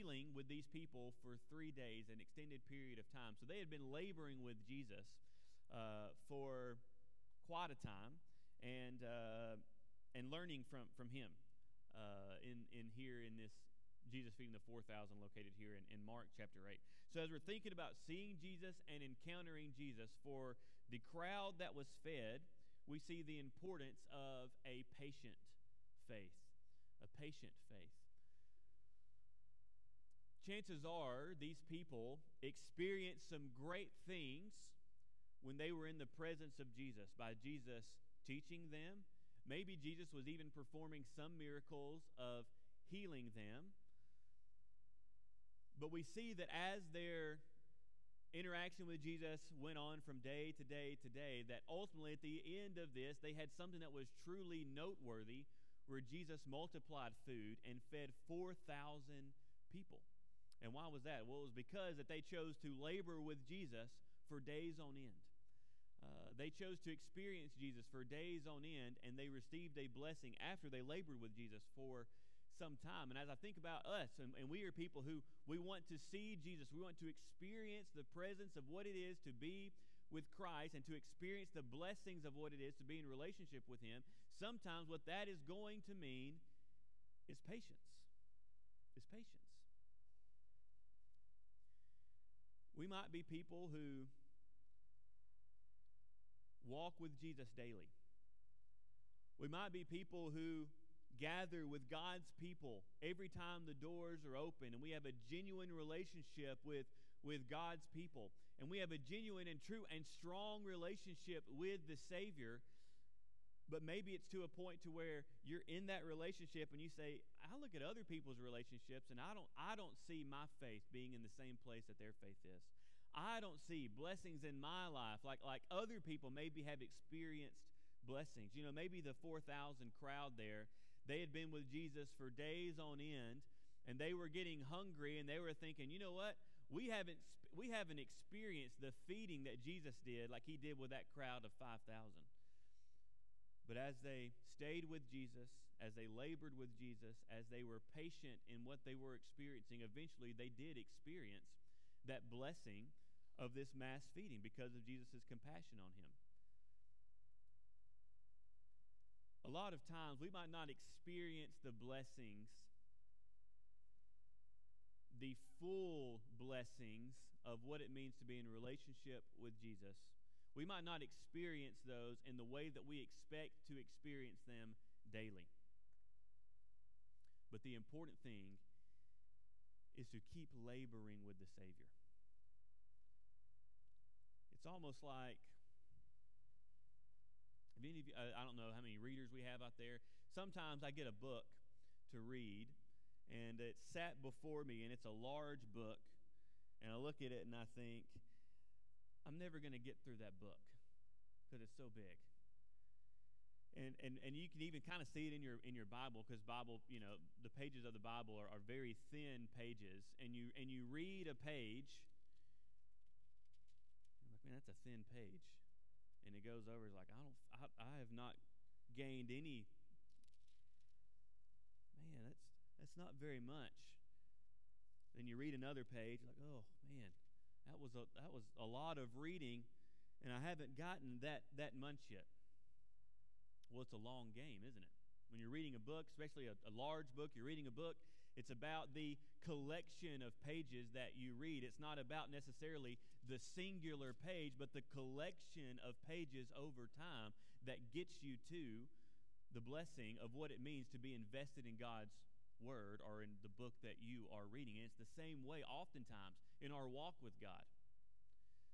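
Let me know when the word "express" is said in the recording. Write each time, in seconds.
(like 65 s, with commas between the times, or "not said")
not said.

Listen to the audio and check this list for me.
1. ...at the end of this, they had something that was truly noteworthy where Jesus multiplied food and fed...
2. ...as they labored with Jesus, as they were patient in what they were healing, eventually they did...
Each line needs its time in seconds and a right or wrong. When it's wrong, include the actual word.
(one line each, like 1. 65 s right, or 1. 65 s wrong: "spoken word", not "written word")
1. 52 s right
2. 145 s wrong: "experiencing", not "healing".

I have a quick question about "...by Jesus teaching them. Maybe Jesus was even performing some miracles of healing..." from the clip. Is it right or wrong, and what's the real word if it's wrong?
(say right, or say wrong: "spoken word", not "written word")
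right.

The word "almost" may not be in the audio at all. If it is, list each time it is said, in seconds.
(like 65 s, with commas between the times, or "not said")
184 s.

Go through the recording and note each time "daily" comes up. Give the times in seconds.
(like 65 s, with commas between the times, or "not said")
97 s, 175 s.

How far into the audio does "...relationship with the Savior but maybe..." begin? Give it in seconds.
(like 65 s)
110 s.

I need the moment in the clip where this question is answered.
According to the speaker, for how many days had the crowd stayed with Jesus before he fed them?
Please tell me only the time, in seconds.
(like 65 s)
1 s.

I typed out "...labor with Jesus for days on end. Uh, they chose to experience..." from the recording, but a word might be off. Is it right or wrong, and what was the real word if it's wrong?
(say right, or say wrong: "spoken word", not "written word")
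right.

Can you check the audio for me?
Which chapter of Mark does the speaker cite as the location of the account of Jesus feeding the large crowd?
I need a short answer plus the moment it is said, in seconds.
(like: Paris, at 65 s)
Chapter 8, at 16 s.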